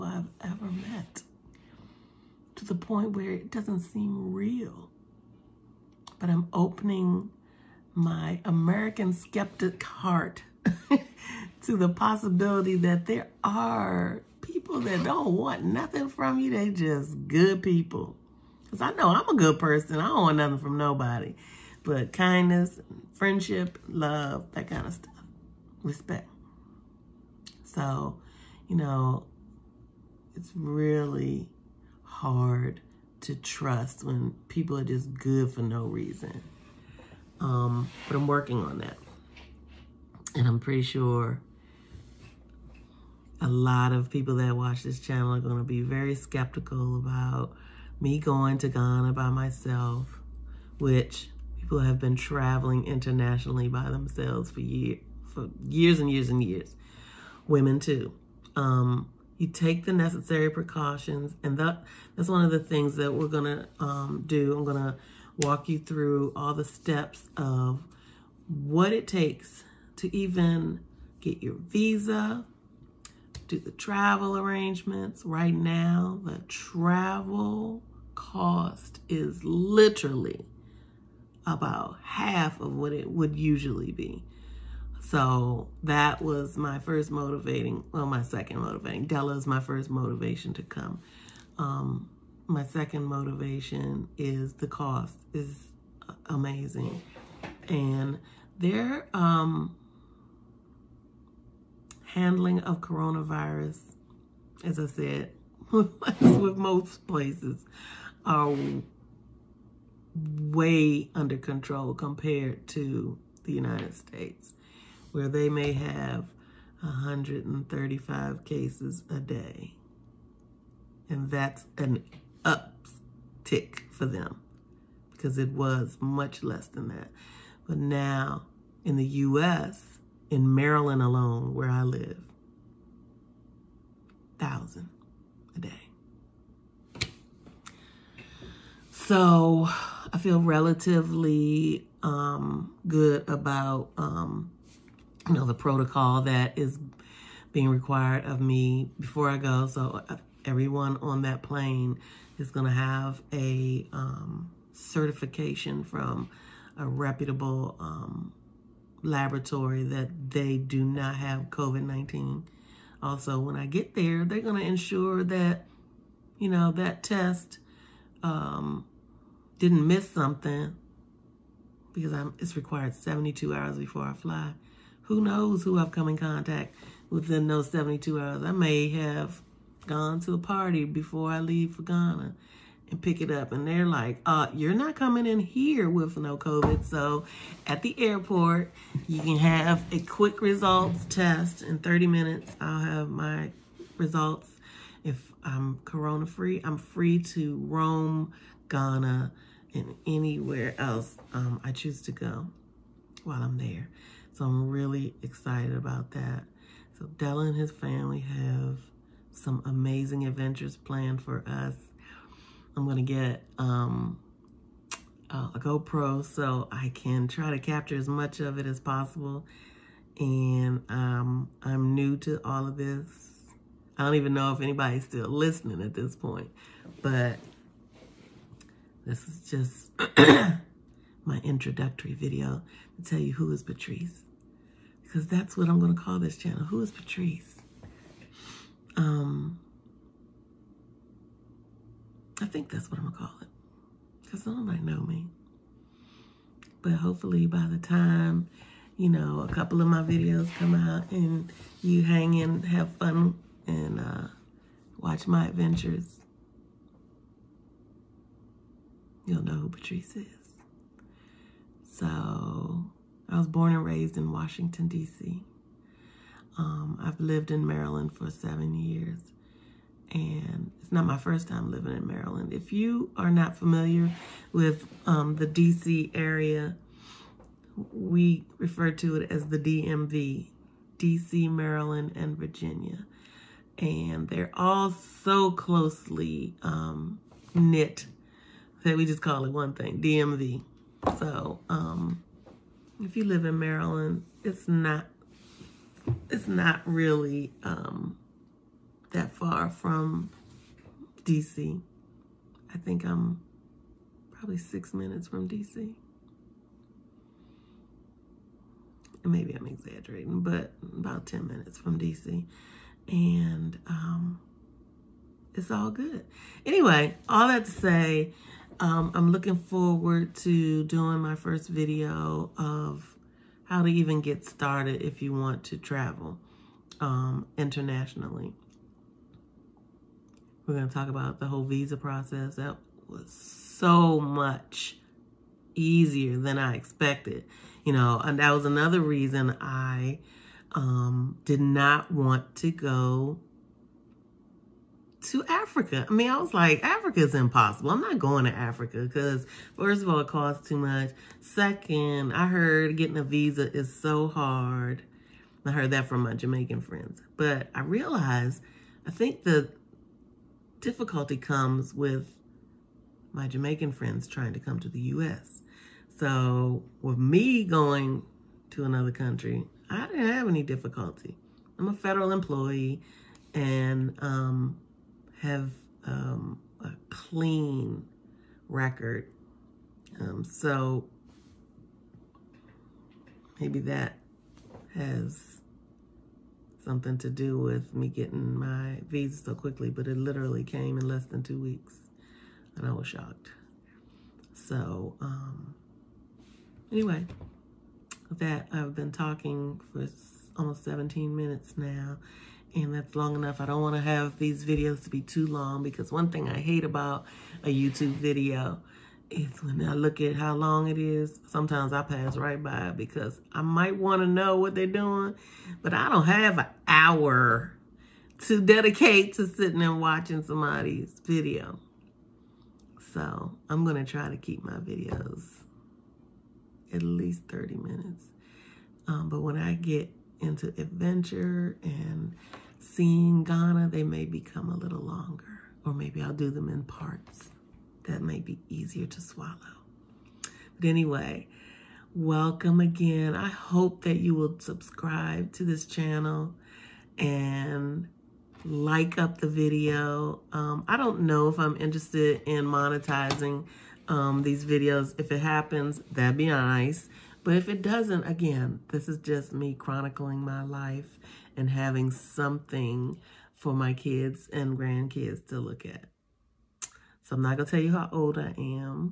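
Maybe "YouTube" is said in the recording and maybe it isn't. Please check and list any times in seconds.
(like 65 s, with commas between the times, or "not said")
407 s.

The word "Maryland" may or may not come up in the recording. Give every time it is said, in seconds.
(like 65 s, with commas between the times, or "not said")
130 s, 267 s, 272 s, 281 s, 293 s.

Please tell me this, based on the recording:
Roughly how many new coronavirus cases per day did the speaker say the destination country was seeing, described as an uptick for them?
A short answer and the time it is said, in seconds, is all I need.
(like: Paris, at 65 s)
135, at 116 s.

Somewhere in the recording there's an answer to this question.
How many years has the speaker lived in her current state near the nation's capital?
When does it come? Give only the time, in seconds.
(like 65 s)
268 s.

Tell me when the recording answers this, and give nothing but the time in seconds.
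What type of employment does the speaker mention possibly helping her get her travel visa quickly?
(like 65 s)
371 s.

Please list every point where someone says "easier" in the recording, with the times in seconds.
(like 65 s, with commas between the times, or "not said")
335 s, 438 s.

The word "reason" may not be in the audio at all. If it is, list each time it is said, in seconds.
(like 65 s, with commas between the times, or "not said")
35 s, 339 s.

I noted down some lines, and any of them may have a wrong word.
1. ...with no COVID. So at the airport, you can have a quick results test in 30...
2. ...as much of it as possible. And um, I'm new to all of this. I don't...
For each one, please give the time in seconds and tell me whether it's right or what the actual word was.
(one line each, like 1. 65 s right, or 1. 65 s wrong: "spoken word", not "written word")
1. 185 s right
2. 217 s right.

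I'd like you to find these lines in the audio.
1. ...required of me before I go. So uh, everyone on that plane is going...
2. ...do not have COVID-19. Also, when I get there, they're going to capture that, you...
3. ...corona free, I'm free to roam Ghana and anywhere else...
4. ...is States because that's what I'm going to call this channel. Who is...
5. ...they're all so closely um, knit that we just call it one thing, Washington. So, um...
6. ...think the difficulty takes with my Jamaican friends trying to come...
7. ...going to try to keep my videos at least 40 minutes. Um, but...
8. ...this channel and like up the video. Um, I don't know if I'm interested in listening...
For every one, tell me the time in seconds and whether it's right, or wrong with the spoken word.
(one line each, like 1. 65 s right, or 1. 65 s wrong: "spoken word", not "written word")
1. 147 s right
2. 160 s wrong: "ensure", not "capture"
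3. 195 s right
4. 233 s wrong: "Patrice", not "States"
5. 284 s wrong: "DMV", not "Washington"
6. 359 s wrong: "comes", not "takes"
7. 423 s wrong: "30", not "40"
8. 445 s wrong: "monetizing", not "listening".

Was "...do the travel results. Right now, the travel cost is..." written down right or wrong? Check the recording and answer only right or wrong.
wrong.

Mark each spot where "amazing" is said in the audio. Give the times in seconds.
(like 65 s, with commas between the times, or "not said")
96 s, 209 s.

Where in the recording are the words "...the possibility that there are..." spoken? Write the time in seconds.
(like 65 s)
11 s.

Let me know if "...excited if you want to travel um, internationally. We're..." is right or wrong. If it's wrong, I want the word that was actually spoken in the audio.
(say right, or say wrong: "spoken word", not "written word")
wrong: "started", not "excited".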